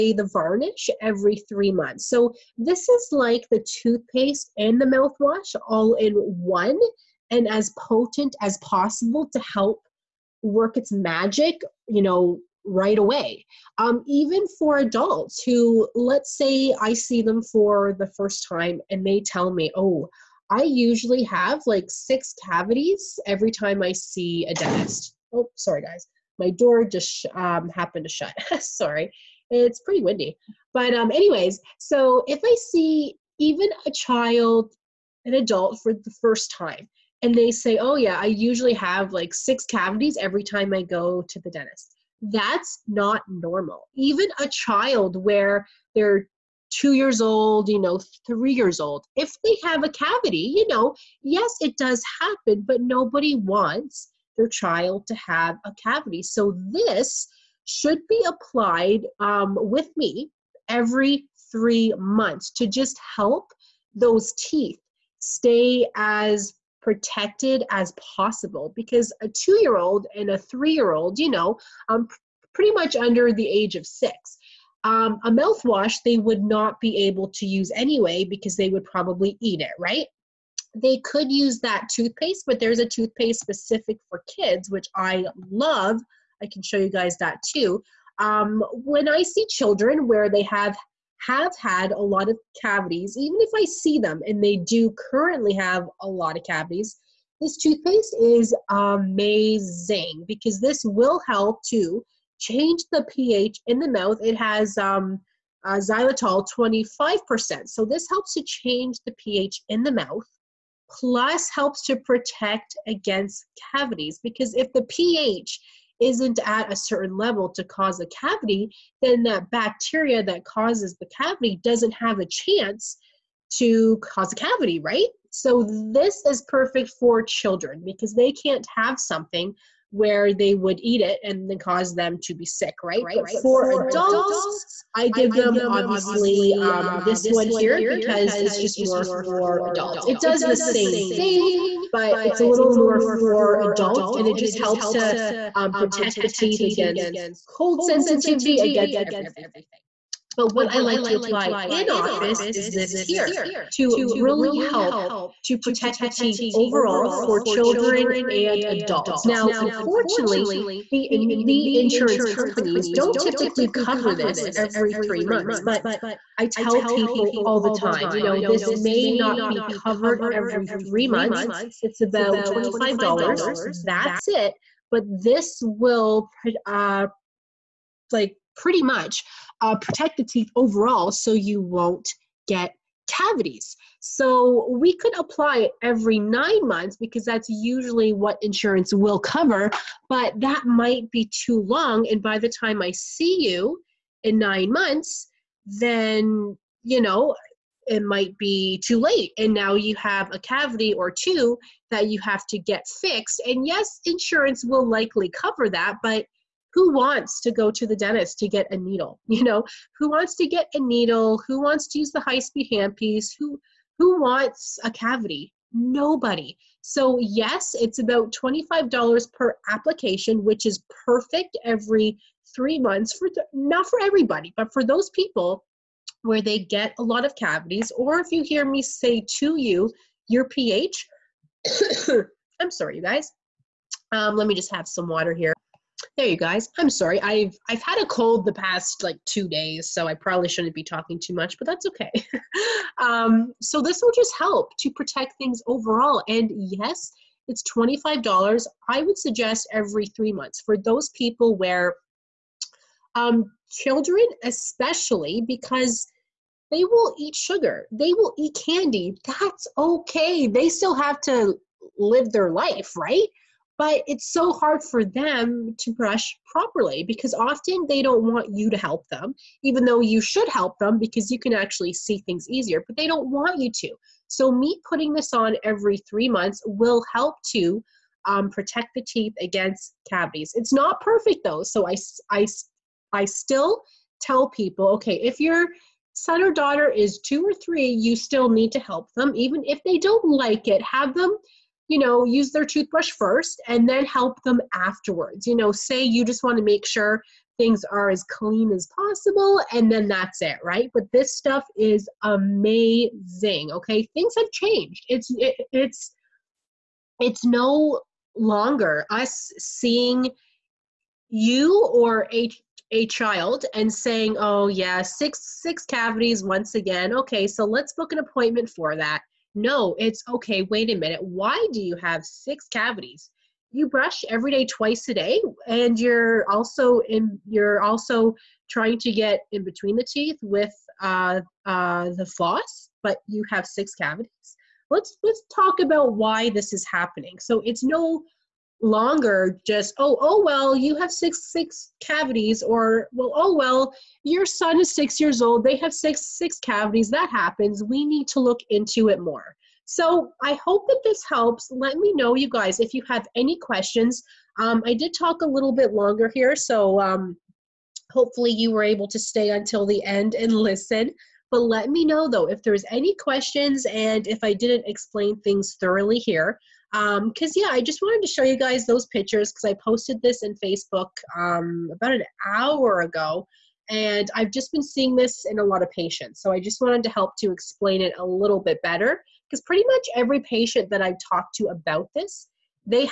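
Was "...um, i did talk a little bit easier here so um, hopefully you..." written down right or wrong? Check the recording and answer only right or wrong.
wrong.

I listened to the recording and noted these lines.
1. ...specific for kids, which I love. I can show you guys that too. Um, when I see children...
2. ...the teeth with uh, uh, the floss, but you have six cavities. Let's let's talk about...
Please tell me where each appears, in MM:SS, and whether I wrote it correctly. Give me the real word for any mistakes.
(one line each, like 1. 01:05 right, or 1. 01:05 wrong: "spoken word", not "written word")
1. 01:23 right
2. 05:29 right.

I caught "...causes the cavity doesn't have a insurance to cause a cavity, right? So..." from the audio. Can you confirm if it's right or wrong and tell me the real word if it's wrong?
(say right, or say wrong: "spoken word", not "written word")
wrong: "chance", not "insurance".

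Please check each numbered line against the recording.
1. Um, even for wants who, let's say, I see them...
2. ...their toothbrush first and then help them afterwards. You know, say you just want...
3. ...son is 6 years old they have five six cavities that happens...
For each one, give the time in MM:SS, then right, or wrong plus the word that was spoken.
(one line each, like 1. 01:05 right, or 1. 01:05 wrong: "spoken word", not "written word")
1. 00:13 wrong: "adults", not "wants"
2. 04:52 right
3. 05:44 wrong: "six", not "five".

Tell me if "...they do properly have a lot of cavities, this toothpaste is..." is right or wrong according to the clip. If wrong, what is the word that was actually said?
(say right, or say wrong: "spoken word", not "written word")
wrong: "currently", not "properly".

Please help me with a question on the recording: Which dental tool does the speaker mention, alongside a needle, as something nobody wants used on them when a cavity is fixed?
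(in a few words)
high speed handpiece.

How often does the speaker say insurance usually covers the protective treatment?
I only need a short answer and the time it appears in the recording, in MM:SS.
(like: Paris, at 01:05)
every 9 months, at 03:05.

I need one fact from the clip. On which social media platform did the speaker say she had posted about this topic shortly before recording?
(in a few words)
Facebook.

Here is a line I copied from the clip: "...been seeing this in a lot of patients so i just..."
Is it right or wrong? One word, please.
right.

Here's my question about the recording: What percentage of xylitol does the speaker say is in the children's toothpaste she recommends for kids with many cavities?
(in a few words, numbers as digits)
25%.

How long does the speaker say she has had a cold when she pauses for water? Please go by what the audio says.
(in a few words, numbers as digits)
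2 days.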